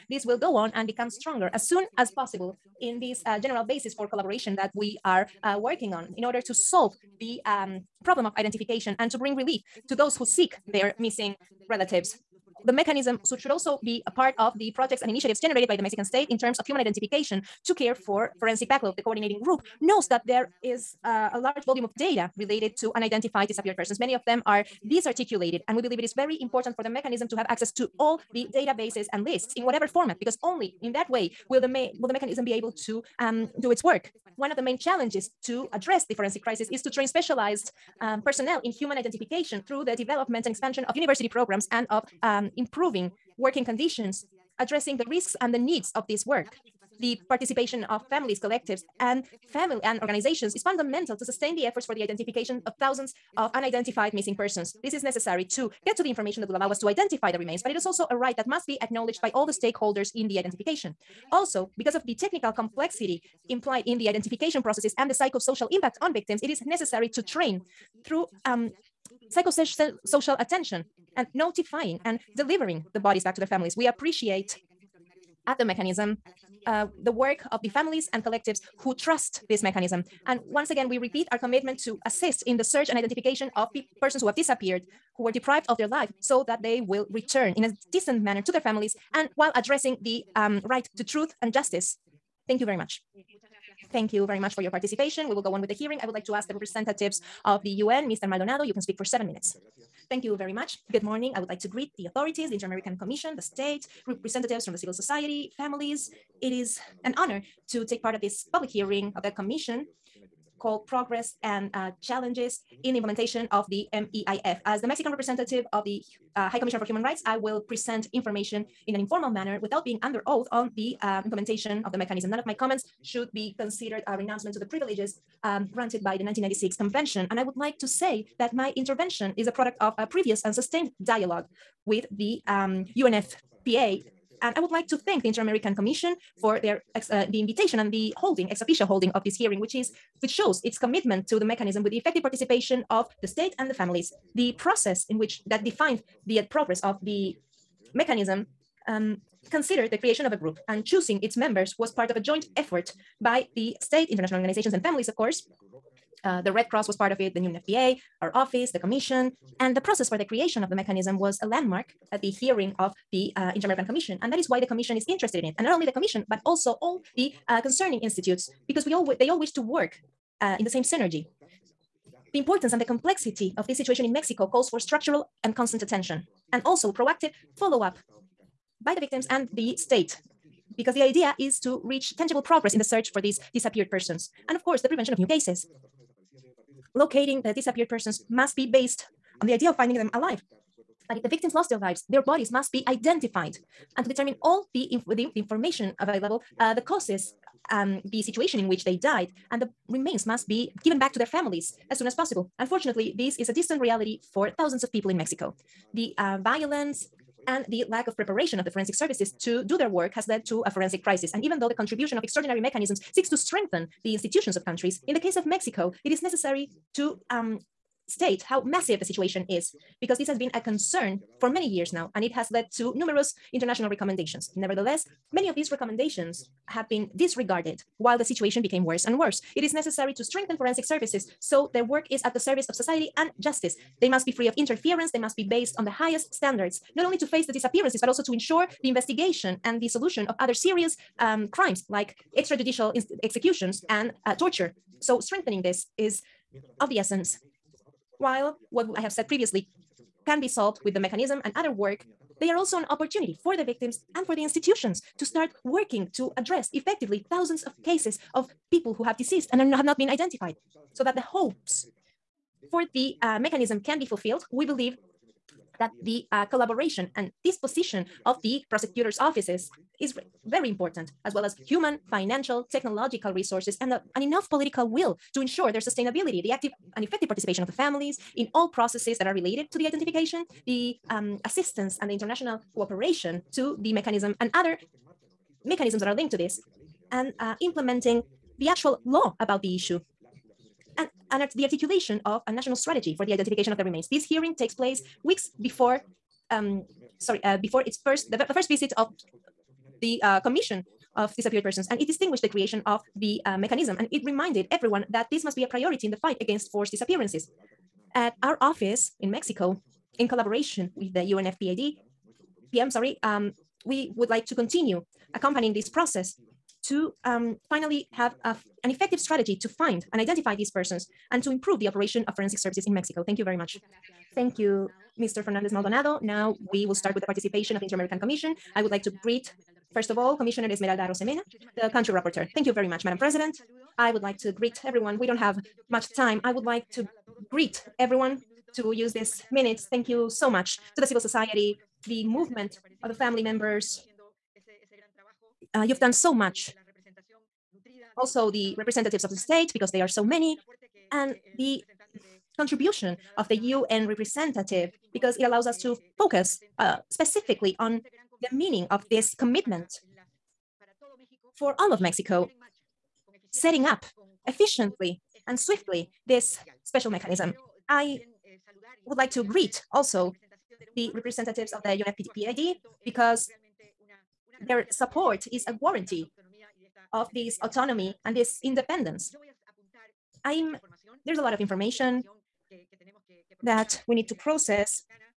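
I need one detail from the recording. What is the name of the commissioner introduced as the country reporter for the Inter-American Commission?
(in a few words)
Esmeralda Arosemena.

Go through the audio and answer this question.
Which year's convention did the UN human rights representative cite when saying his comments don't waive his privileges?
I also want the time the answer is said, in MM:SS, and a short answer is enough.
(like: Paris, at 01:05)
1996, at 02:06.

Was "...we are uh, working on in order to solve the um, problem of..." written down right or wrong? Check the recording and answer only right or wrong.
right.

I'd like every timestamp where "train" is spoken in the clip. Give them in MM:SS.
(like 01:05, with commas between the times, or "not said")
00:36, 01:07.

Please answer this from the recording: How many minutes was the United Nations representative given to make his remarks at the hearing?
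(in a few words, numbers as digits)
7.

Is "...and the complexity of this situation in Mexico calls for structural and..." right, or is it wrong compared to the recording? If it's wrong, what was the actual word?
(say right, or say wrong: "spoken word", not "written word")
right.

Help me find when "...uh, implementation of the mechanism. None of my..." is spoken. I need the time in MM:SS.
02:01.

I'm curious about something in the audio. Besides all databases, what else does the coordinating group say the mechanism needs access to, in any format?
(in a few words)
lists.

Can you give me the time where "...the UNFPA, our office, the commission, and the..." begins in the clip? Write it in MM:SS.
02:37.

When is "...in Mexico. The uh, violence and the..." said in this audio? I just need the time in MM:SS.
03:25.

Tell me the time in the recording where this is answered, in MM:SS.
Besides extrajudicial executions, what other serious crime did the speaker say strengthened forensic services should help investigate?
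04:04.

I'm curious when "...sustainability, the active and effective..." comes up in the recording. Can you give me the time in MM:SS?
04:35.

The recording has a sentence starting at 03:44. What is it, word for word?
Nevertheless, many of these recommendations have been disregarded while the situation became worse and worse.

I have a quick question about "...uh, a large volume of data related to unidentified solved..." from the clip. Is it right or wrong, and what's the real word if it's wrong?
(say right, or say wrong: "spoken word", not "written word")
wrong: "disappeared", not "solved".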